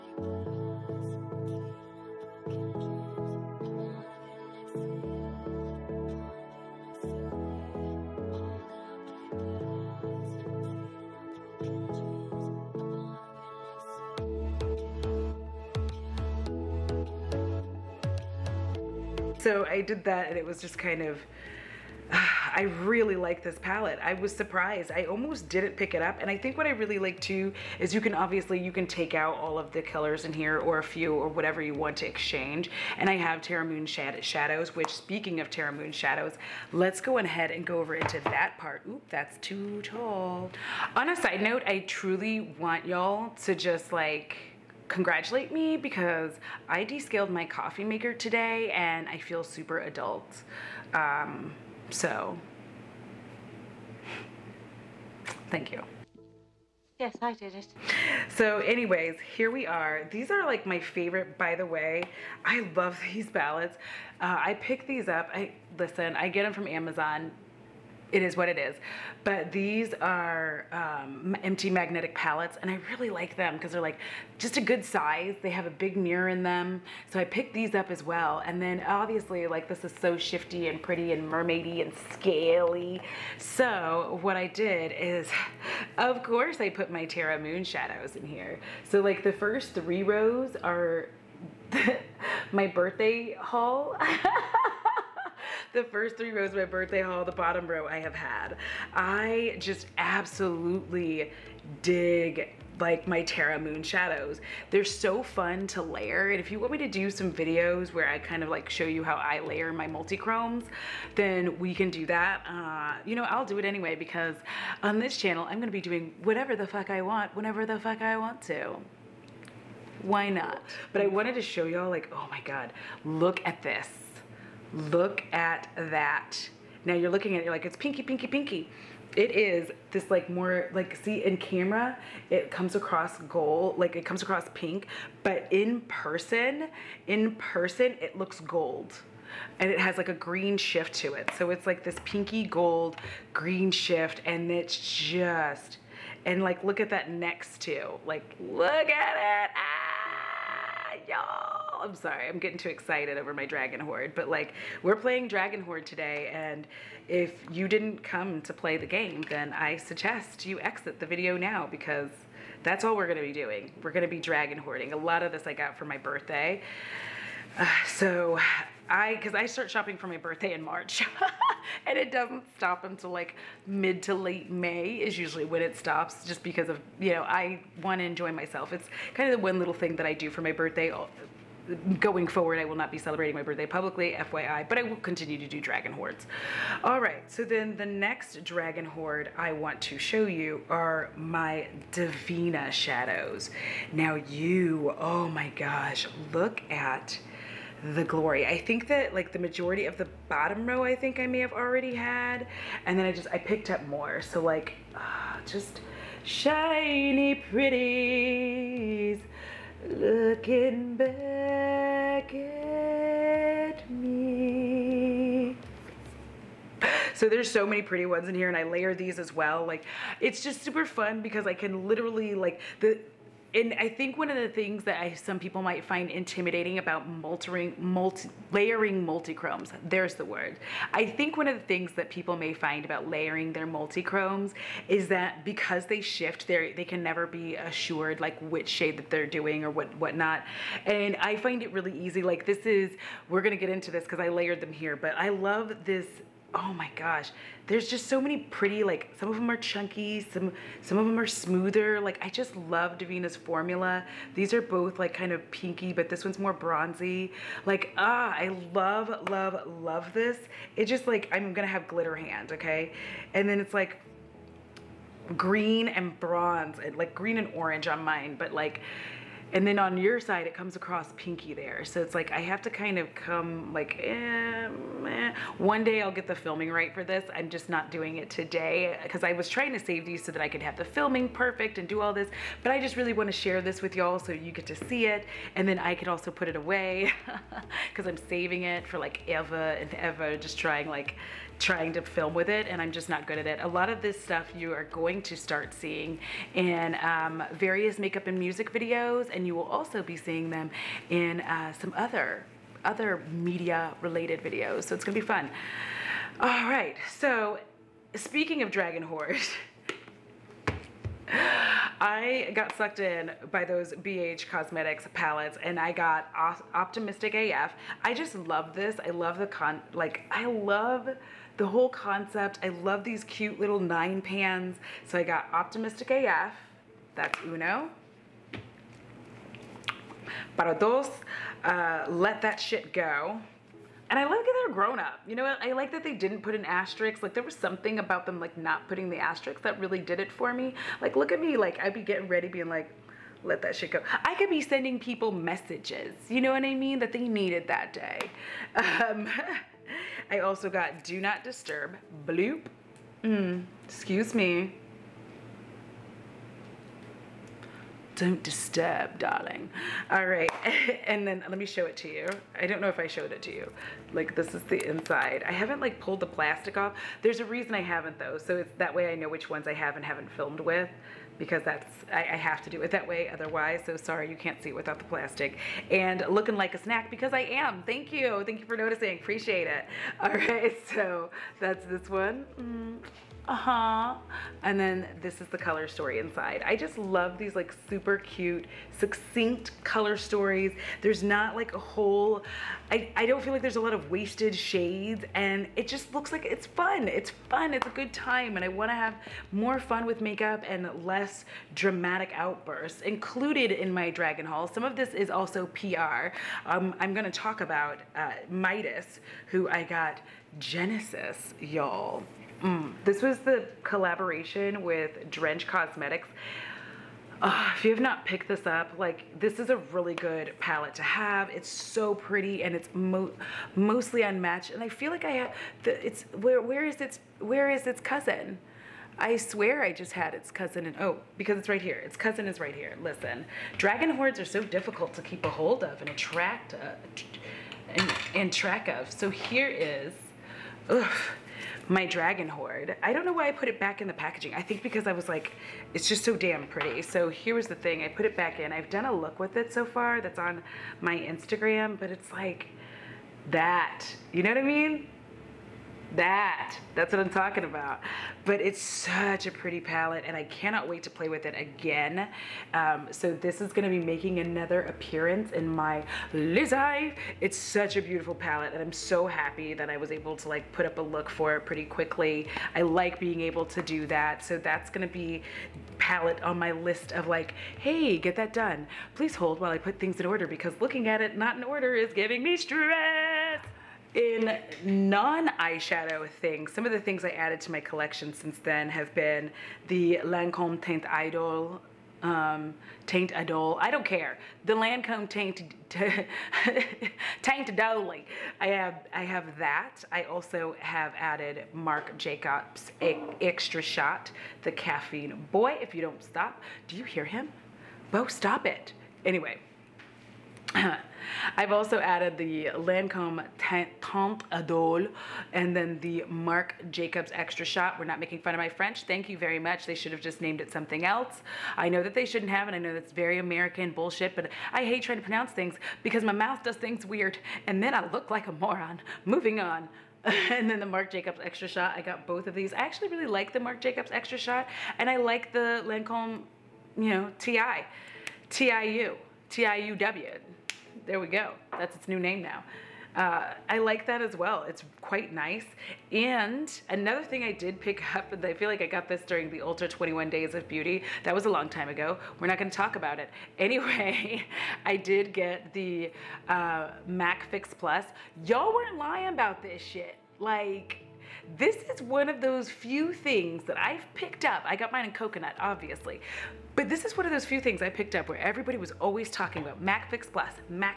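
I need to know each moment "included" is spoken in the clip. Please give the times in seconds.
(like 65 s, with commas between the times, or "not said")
403 s.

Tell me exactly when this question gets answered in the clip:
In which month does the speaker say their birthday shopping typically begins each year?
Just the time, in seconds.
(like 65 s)
170 s.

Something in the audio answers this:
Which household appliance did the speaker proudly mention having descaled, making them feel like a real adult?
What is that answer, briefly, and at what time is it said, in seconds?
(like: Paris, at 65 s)
Coffee maker, at 47 s.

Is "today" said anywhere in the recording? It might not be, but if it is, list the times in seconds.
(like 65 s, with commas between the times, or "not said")
48 s, 155 s, 278 s.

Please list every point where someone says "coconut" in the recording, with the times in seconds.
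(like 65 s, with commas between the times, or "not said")
565 s.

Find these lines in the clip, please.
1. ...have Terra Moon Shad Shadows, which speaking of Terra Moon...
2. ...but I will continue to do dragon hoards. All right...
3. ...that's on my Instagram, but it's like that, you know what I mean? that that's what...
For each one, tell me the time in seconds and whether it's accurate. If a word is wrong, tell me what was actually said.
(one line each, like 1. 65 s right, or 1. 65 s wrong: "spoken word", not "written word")
1. 33 s right
2. 184 s right
3. 450 s right.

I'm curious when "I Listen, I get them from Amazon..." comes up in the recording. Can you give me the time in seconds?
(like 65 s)
65 s.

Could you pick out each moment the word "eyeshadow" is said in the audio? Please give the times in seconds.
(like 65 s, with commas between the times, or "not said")
484 s.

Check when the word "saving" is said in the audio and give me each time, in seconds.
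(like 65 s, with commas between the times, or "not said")
288 s.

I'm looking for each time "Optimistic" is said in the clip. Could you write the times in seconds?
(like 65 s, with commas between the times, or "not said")
316 s, 325 s.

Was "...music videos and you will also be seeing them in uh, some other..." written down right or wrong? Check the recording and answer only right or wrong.
right.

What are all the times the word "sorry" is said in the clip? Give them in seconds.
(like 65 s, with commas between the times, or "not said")
151 s, 373 s.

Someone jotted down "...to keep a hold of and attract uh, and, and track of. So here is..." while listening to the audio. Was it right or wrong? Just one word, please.
right.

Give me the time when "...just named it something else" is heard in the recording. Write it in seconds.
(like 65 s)
520 s.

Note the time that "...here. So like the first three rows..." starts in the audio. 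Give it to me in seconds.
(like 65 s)
88 s.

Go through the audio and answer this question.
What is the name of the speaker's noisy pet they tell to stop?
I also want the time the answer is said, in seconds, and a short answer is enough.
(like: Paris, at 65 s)
Bo, at 508 s.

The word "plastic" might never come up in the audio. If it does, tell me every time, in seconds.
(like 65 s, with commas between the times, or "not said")
366 s, 375 s.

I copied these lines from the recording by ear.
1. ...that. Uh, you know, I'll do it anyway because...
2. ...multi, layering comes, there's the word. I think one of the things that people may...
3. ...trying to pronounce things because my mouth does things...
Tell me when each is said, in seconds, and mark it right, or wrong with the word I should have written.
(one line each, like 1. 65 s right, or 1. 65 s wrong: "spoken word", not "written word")
1. 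112 s right
2. 227 s wrong: "multichromes", not "comes"
3. 525 s right.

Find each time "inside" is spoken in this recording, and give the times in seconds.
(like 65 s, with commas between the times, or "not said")
364 s, 386 s.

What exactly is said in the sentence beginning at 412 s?
Mm, this was the collaboration with Drench Cosmetics.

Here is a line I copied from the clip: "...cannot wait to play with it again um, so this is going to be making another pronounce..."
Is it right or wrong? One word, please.
wrong.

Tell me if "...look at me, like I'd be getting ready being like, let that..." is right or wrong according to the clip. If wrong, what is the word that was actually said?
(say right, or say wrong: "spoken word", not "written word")
right.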